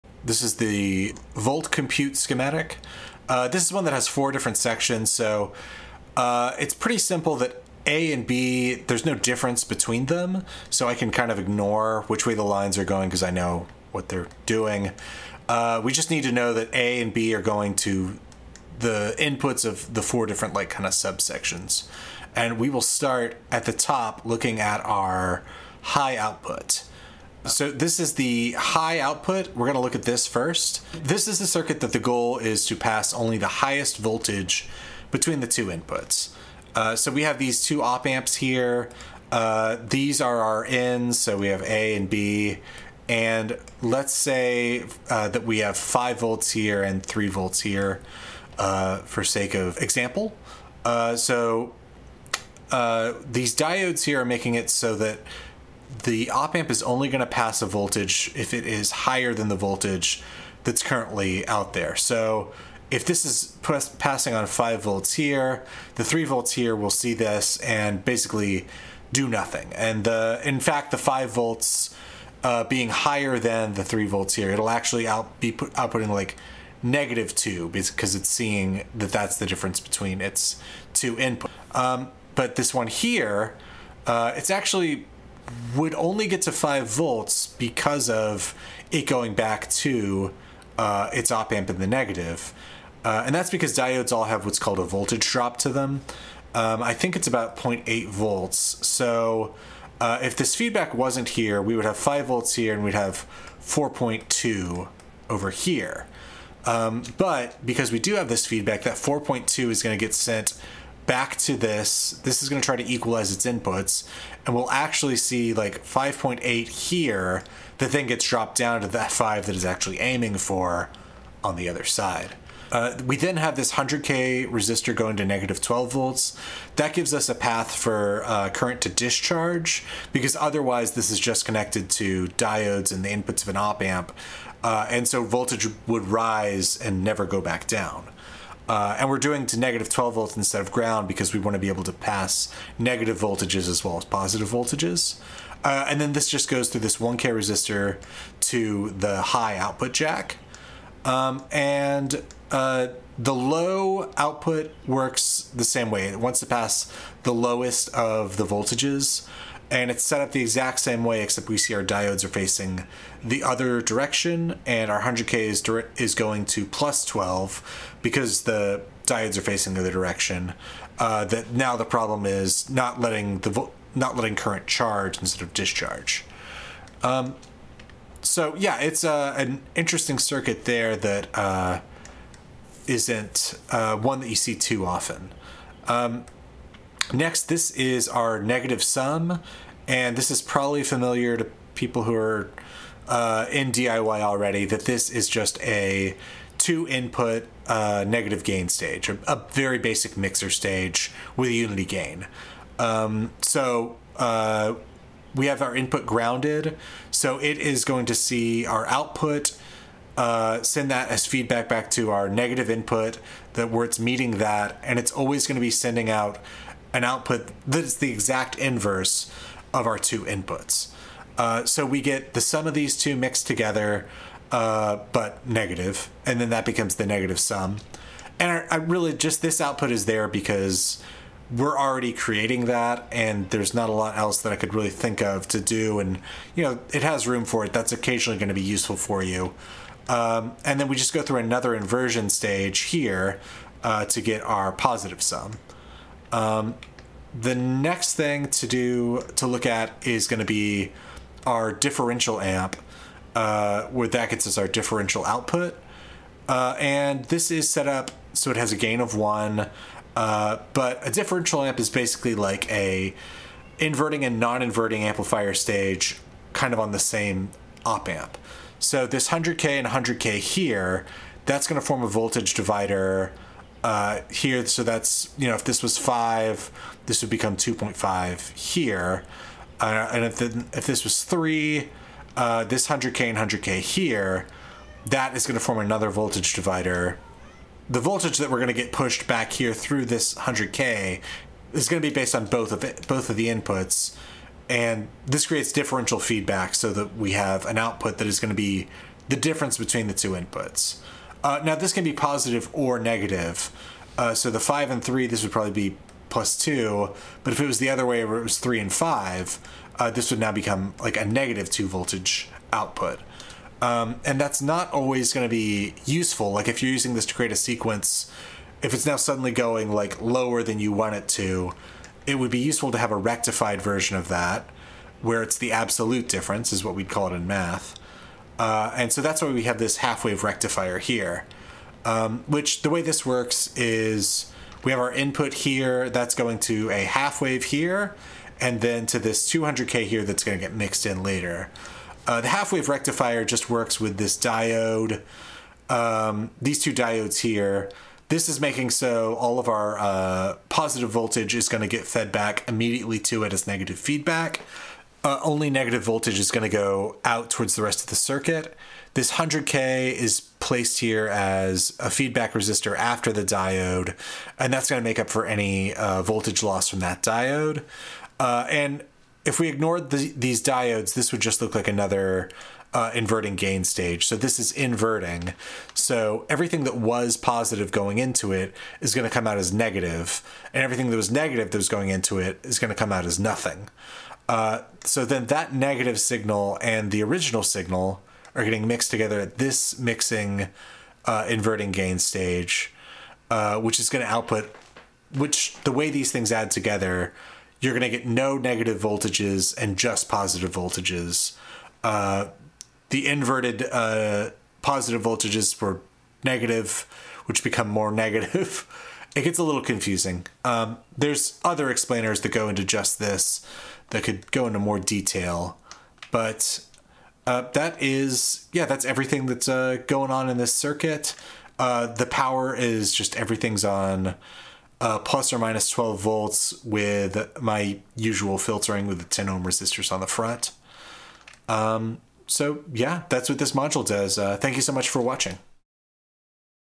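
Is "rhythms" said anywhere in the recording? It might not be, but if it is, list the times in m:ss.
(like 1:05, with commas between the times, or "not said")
not said.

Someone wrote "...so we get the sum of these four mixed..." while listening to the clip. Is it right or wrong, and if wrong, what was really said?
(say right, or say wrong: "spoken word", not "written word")
wrong: "two", not "four".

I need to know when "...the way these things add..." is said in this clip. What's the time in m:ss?
6:35.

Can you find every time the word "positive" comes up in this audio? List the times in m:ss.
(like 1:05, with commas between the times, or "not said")
2:24, 4:04, 5:02, 5:50, 6:17, 6:40, 6:44.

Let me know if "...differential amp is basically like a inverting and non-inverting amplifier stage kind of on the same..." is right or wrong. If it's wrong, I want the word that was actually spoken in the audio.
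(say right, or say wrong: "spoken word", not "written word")
right.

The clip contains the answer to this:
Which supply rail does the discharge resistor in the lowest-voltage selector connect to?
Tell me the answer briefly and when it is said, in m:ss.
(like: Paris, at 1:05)
plus 12, at 2:46.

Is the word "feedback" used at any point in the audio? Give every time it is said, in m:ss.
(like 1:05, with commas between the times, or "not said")
1:40, 1:48, 3:31, 4:56, 5:53, 6:02.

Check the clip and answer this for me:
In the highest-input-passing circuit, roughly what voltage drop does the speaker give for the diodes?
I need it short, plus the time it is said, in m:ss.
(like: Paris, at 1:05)
0.8 volts, at 1:37.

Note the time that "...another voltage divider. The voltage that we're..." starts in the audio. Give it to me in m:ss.
4:45.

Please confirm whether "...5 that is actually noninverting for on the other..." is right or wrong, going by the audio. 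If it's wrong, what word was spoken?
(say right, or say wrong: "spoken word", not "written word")
wrong: "aiming", not "noninverting".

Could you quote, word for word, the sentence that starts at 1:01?
So if this is passing on 5 volts here, the 3 volts here will see this and basically do nothing.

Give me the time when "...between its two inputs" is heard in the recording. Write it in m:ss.
1:19.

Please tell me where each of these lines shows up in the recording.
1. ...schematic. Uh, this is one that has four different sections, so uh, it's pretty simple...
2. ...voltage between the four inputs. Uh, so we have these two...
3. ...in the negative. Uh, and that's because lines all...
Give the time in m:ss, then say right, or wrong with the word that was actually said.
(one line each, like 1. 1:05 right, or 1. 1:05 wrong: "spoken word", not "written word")
1. 0:02 right
2. 0:33 wrong: "two", not "four"
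3. 1:31 wrong: "diodes", not "lines".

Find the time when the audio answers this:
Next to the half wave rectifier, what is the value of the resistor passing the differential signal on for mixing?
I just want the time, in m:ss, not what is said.
5:39.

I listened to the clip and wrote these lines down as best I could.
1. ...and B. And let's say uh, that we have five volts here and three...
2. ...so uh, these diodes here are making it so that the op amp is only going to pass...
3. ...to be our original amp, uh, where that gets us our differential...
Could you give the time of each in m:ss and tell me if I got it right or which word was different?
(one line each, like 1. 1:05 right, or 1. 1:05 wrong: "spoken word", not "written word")
1. 0:41 right
2. 0:51 right
3. 4:10 wrong: "differential", not "original".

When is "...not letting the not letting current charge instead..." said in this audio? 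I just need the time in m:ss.
2:52.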